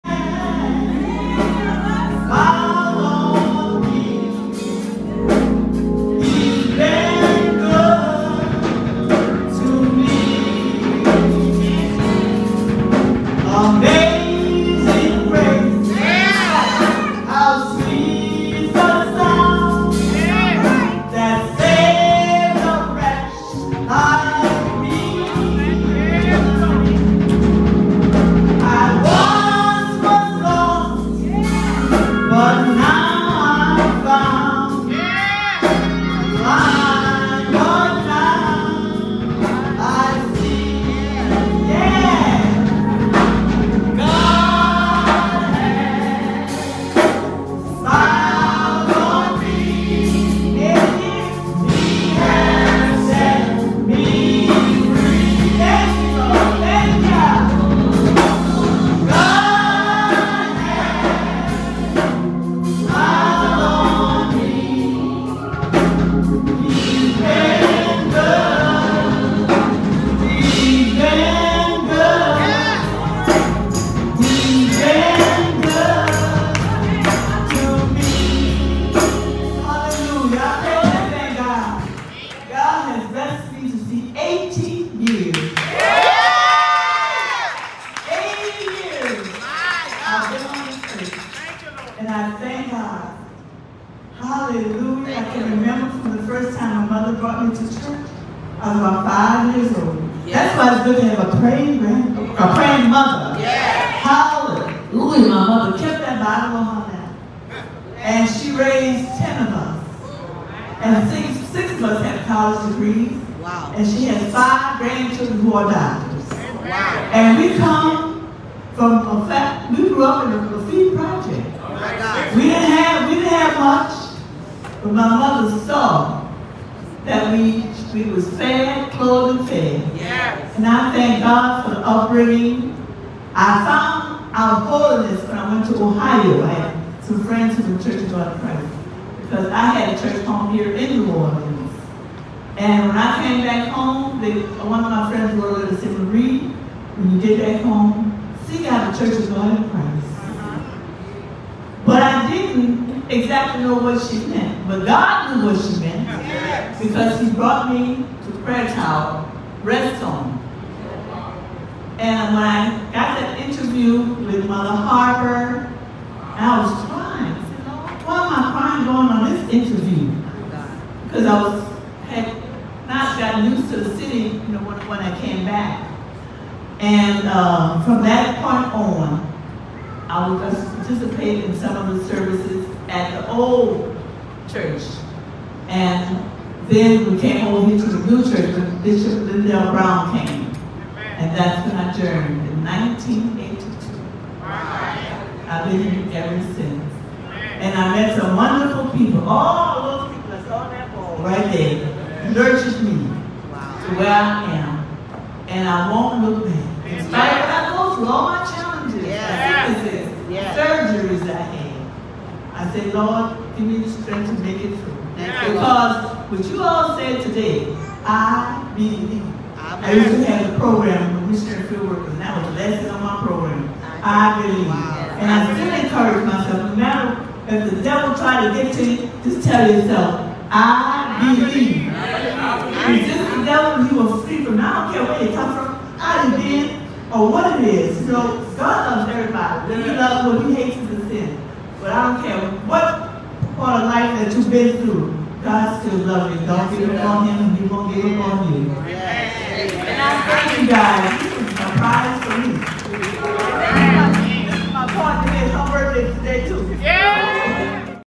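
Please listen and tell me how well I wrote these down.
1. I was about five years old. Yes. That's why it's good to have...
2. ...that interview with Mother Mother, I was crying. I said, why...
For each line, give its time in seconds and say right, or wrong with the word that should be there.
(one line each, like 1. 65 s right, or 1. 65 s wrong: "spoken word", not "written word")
1. 98 s right
2. 163 s wrong: "Harper", not "Mother".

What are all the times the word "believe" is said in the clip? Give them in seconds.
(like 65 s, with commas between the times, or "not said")
218 s, 224 s, 231 s.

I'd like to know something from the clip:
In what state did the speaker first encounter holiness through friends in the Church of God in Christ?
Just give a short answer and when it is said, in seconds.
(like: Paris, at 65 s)
Ohio, at 135 s.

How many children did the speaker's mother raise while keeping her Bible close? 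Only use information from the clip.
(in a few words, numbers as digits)
10.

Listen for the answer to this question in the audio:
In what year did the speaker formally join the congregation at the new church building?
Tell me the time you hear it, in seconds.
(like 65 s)
192 s.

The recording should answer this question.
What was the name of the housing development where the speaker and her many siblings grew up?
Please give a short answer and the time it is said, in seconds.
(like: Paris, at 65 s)
Lafitte Project, at 120 s.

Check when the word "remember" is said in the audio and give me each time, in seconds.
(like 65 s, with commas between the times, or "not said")
95 s.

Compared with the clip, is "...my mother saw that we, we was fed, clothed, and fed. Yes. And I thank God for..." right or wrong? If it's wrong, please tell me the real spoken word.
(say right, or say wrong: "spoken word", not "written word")
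right.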